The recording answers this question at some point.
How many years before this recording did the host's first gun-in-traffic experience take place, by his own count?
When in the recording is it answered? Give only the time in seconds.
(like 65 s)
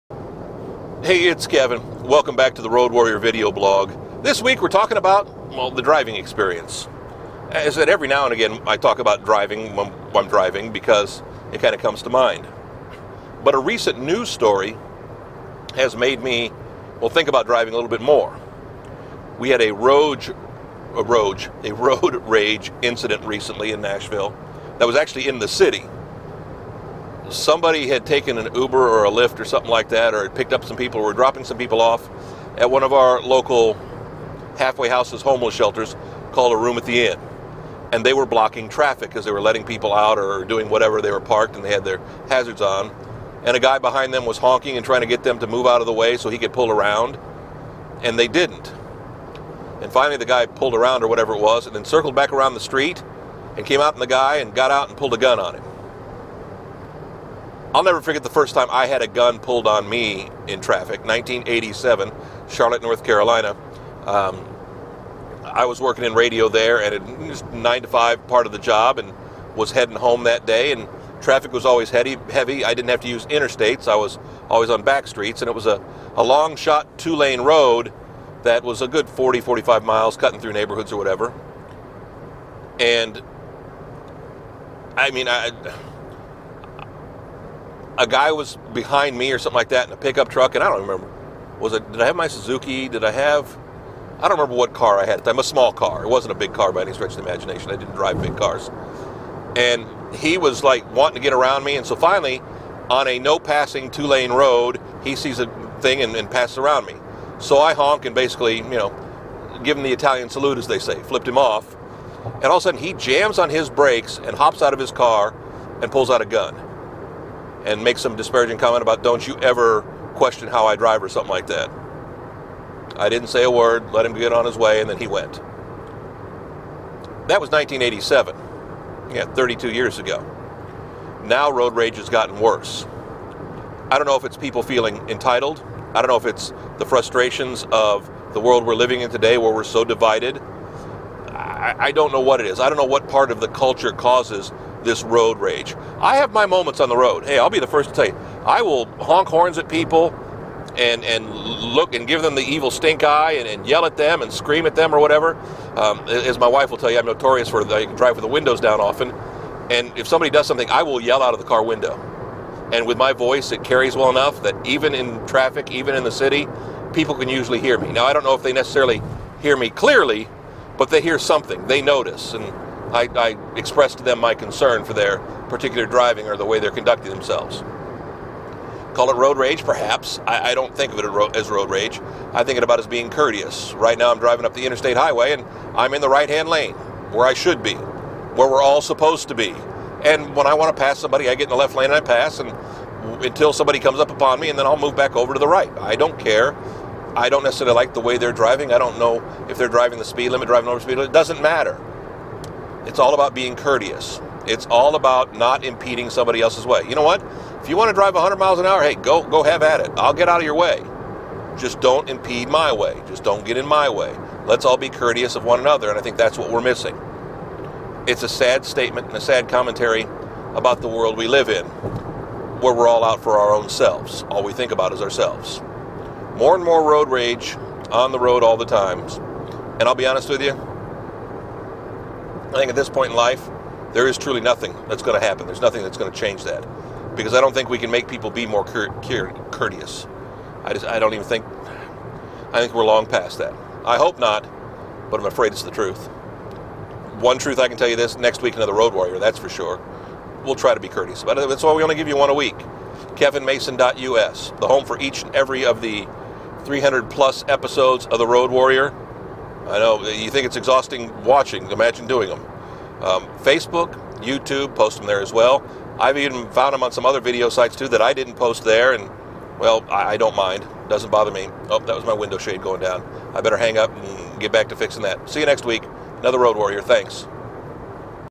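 129 s.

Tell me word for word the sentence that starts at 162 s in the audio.
And with my voice, it carries well enough that even in traffic, even in the city, people can usually hear me.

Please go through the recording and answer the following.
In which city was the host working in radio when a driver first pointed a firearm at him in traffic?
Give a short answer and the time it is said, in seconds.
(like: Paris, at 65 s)
Charlotte, North Carolina, at 62 s.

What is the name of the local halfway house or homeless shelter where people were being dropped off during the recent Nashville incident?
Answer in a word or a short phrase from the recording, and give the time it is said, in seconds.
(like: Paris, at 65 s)
Room at the Inn, at 36 s.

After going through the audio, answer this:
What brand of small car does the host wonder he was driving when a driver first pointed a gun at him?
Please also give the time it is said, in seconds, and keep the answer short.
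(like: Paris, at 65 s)
Suzuki, at 92 s.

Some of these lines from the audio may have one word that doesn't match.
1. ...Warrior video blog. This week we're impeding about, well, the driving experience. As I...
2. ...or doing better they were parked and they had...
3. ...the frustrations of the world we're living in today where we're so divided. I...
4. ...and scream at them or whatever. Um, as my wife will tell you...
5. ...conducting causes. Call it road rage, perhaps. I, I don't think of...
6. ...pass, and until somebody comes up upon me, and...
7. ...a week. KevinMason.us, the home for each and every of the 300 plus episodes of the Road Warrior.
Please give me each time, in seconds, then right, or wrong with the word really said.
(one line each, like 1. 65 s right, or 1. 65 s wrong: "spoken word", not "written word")
1. 2 s wrong: "talking", not "impeding"
2. 40 s wrong: "whatever", not "better"
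3. 136 s right
4. 154 s right
5. 176 s wrong: "themselves", not "causes"
6. 191 s right
7. 252 s right.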